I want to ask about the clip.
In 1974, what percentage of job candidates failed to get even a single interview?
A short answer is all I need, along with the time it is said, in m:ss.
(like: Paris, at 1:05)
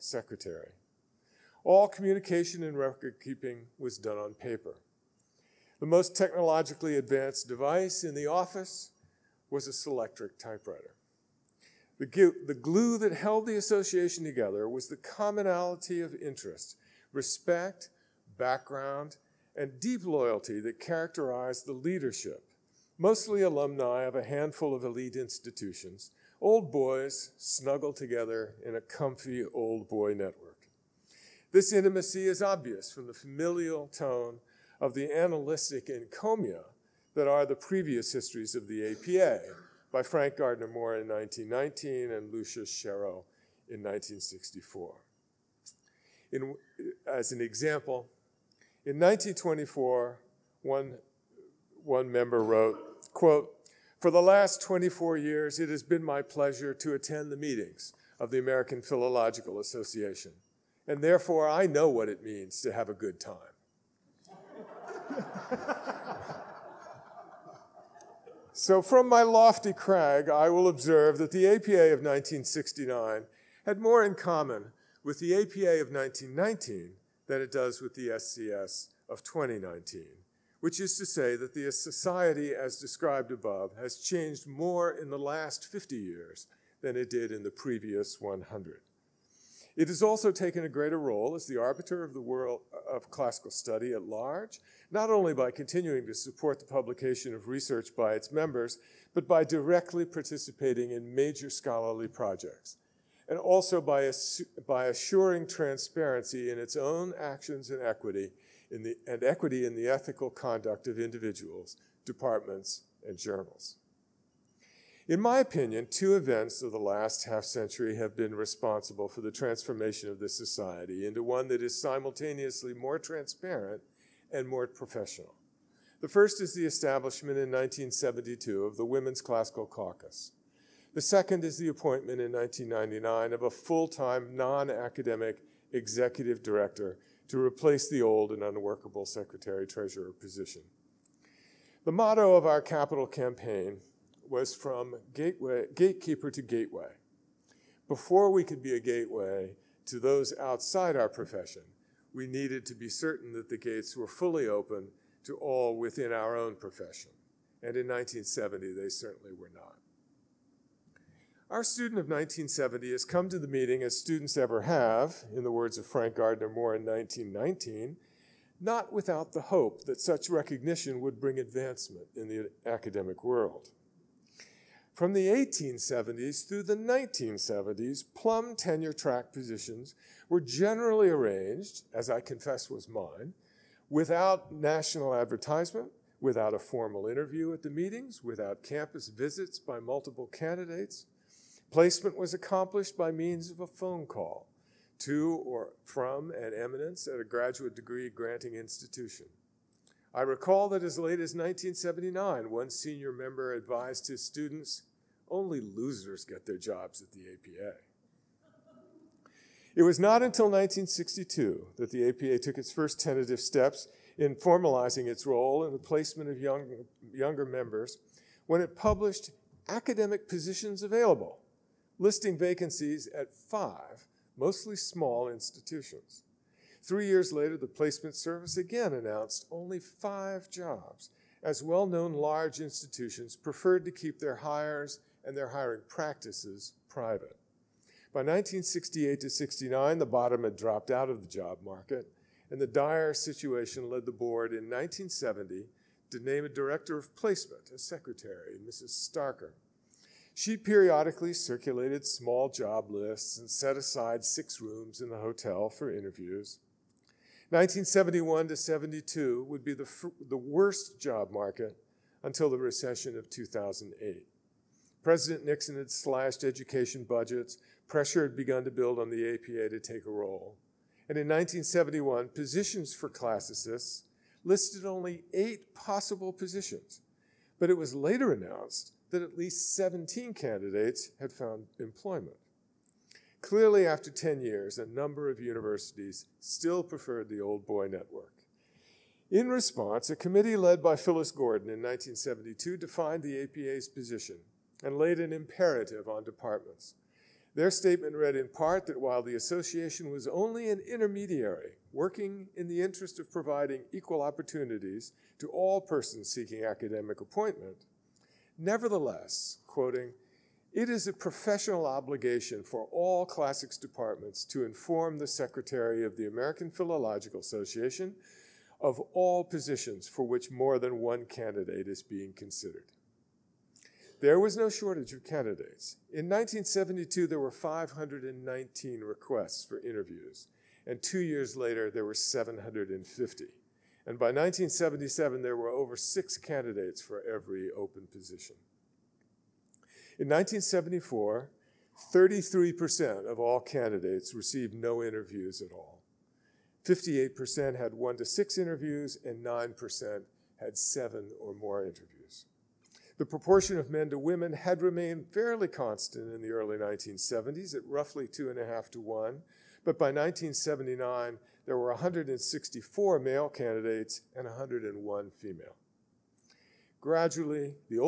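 33%, at 5:42.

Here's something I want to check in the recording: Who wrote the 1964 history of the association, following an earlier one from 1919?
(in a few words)
Lucius Shero.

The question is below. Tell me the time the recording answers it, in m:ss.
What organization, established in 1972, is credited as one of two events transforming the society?
2:08.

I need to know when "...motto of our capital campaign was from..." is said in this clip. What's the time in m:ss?
2:21.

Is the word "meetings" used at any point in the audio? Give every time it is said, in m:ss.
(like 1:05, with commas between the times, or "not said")
0:57, 2:43, 3:07.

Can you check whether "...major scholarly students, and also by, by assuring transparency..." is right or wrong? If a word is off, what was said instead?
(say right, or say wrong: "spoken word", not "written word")
wrong: "projects", not "students".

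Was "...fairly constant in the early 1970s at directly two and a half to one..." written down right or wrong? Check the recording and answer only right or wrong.
wrong.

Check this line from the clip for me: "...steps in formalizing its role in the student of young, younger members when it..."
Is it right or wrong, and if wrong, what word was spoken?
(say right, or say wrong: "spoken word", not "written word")
wrong: "placement", not "student".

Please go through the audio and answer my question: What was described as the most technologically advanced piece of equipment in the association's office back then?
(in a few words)
Selectric typewriter.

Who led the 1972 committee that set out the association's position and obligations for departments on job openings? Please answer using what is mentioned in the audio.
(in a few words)
Phyllis Gordon.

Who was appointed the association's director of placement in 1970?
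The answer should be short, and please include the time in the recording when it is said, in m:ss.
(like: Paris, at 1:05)
Mrs. Starker, at 4:08.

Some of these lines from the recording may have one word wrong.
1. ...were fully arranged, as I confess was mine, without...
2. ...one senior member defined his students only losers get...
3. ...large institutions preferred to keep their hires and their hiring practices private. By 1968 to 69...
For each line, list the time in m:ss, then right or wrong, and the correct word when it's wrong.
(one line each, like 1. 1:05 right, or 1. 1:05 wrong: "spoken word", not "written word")
1. 3:00 wrong: "generally", not "fully"
2. 3:22 wrong: "advised", not "defined"
3. 3:52 right.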